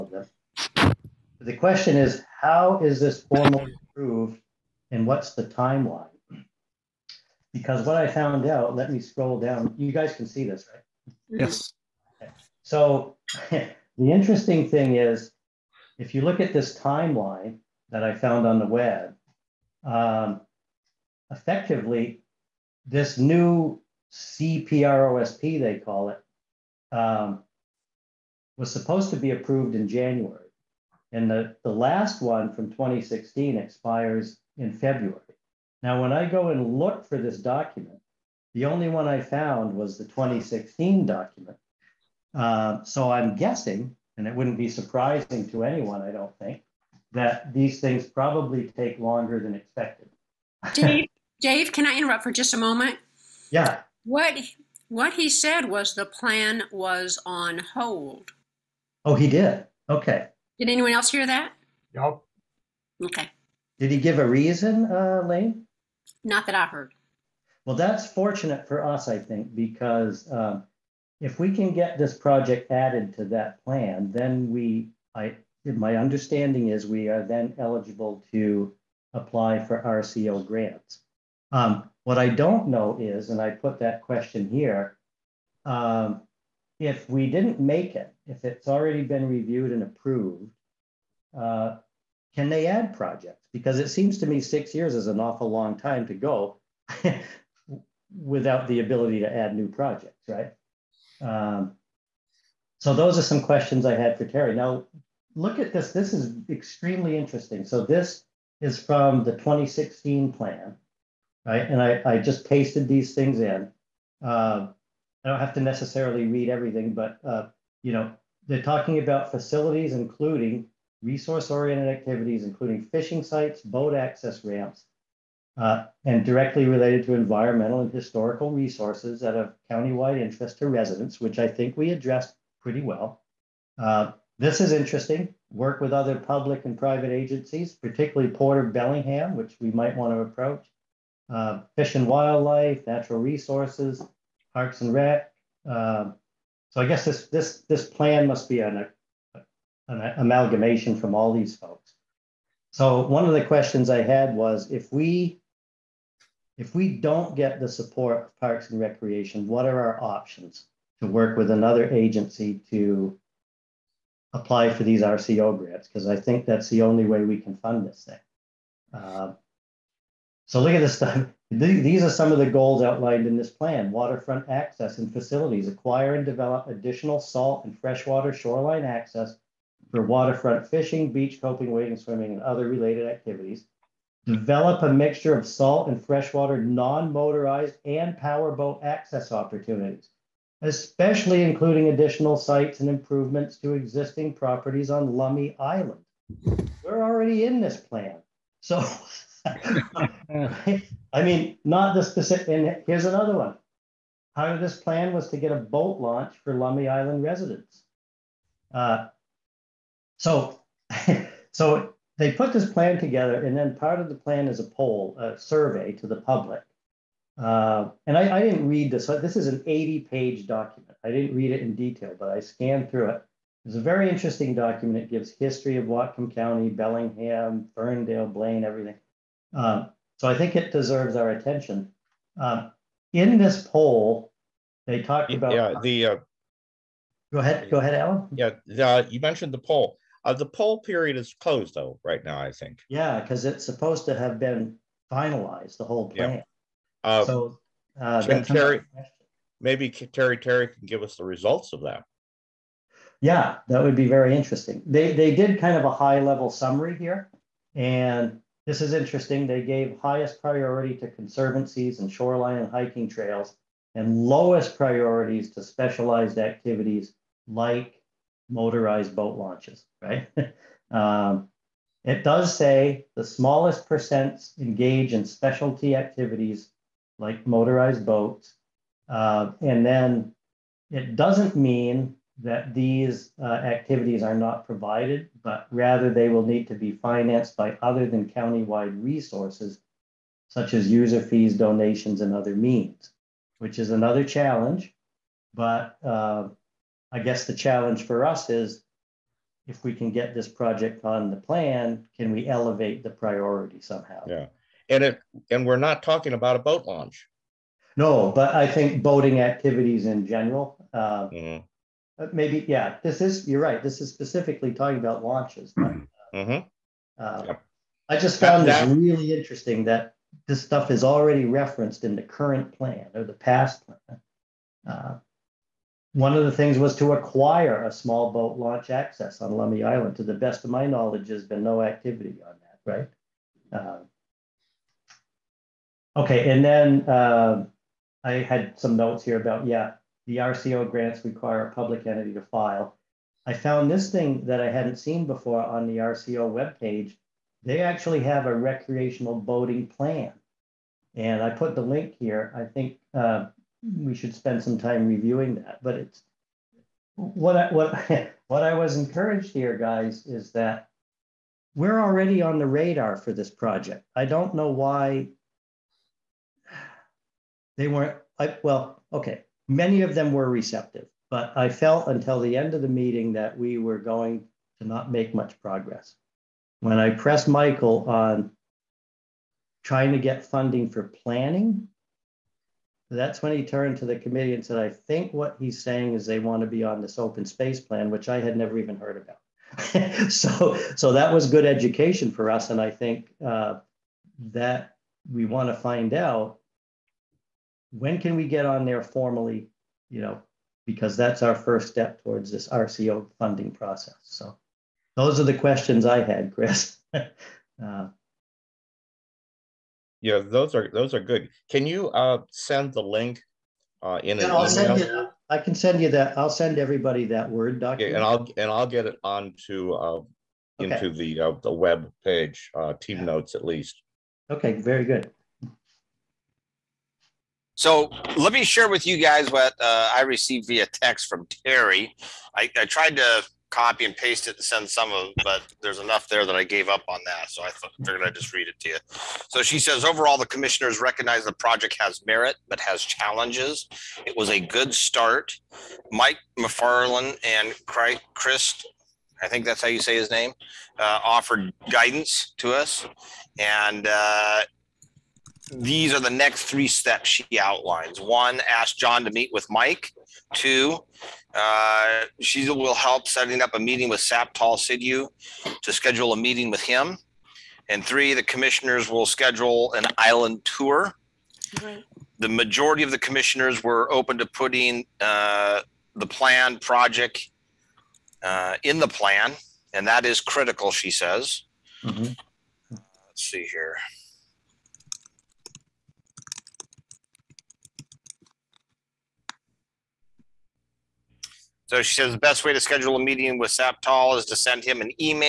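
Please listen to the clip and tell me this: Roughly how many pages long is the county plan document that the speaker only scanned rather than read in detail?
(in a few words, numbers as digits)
80.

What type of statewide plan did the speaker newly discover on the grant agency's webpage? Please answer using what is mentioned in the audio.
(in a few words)
recreational boating plan.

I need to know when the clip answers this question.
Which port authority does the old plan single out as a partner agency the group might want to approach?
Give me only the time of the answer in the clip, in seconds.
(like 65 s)
138 s.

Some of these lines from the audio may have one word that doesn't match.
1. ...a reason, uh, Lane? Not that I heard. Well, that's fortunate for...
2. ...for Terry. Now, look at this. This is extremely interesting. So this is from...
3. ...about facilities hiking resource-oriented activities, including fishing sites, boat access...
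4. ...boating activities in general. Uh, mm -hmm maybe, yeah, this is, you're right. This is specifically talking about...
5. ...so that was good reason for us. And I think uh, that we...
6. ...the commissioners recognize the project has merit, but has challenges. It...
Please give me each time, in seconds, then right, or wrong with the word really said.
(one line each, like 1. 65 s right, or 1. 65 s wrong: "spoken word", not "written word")
1. 64 s right
2. 104 s right
3. 118 s wrong: "including", not "hiking"
4. 309 s right
5. 390 s wrong: "education", not "reason"
6. 440 s right.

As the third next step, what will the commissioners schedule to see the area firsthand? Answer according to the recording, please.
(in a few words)
an island tour.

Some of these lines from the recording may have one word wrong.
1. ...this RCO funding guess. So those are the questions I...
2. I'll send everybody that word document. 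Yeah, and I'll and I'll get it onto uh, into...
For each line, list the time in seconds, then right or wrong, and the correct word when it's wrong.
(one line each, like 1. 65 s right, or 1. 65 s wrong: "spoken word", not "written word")
1. 402 s wrong: "process", not "guess"
2. 416 s right.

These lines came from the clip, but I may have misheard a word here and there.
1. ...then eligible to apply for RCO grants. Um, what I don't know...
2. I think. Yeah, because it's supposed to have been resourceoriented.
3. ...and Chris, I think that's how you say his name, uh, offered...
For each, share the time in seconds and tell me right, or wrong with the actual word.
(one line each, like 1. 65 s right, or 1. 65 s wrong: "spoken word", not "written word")
1. 77 s right
2. 242 s wrong: "finalized", not "resourceoriented"
3. 447 s right.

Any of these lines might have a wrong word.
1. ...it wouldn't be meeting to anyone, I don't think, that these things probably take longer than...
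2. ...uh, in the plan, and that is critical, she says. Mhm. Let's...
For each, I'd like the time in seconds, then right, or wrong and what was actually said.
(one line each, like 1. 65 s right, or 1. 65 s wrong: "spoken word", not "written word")
1. 44 s wrong: "surprising", not "meeting"
2. 478 s right.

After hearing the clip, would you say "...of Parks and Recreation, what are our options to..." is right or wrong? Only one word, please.
right.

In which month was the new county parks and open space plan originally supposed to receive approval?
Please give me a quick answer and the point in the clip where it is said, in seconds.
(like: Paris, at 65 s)
January, at 29 s.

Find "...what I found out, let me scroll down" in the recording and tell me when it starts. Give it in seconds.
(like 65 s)
7 s.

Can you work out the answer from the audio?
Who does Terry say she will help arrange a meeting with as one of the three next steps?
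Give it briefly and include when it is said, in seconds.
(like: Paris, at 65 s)
Satpal Sidhu, at 464 s.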